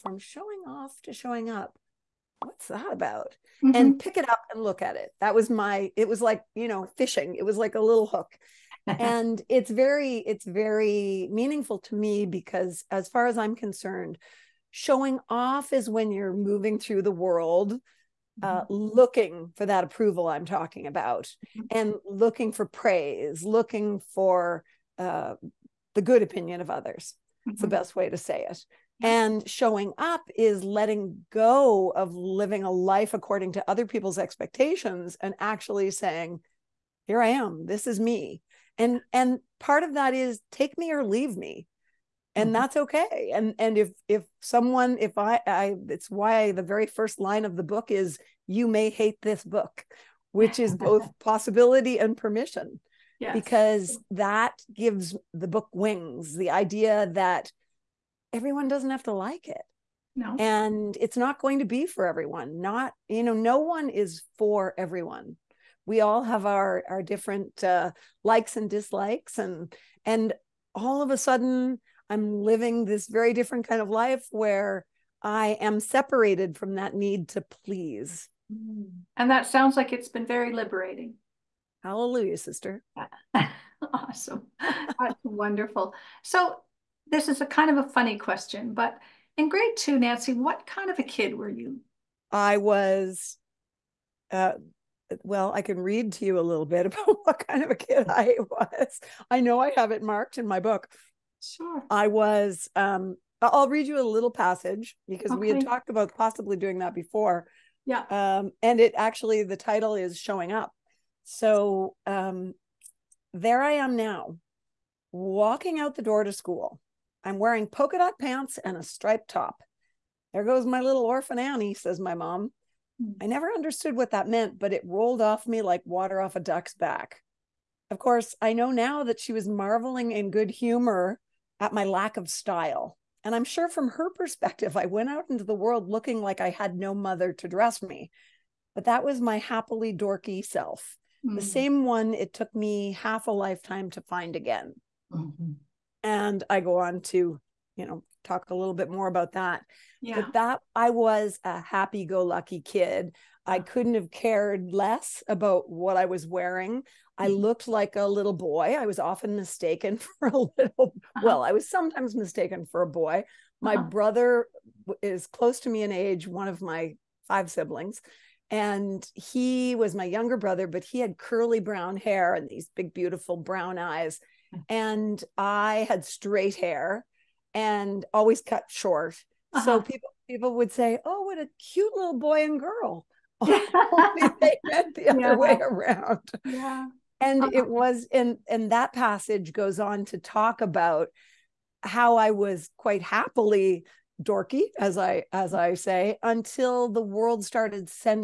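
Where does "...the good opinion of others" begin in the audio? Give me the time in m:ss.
0:25.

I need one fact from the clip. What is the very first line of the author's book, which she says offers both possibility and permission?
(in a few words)
You may hate this book.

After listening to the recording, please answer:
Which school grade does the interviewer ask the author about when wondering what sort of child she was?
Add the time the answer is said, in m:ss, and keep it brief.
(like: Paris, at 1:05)
Grade two, at 1:29.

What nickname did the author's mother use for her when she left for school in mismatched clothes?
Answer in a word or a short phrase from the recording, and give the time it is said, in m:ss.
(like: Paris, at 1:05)
Little orphan Annie, at 2:00.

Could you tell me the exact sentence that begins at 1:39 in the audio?
I know I have it marked in my book.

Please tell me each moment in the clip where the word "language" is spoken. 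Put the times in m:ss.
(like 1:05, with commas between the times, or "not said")
not said.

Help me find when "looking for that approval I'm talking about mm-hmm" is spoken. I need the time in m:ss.
0:18.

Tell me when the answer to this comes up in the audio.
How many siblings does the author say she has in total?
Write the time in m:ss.
2:47.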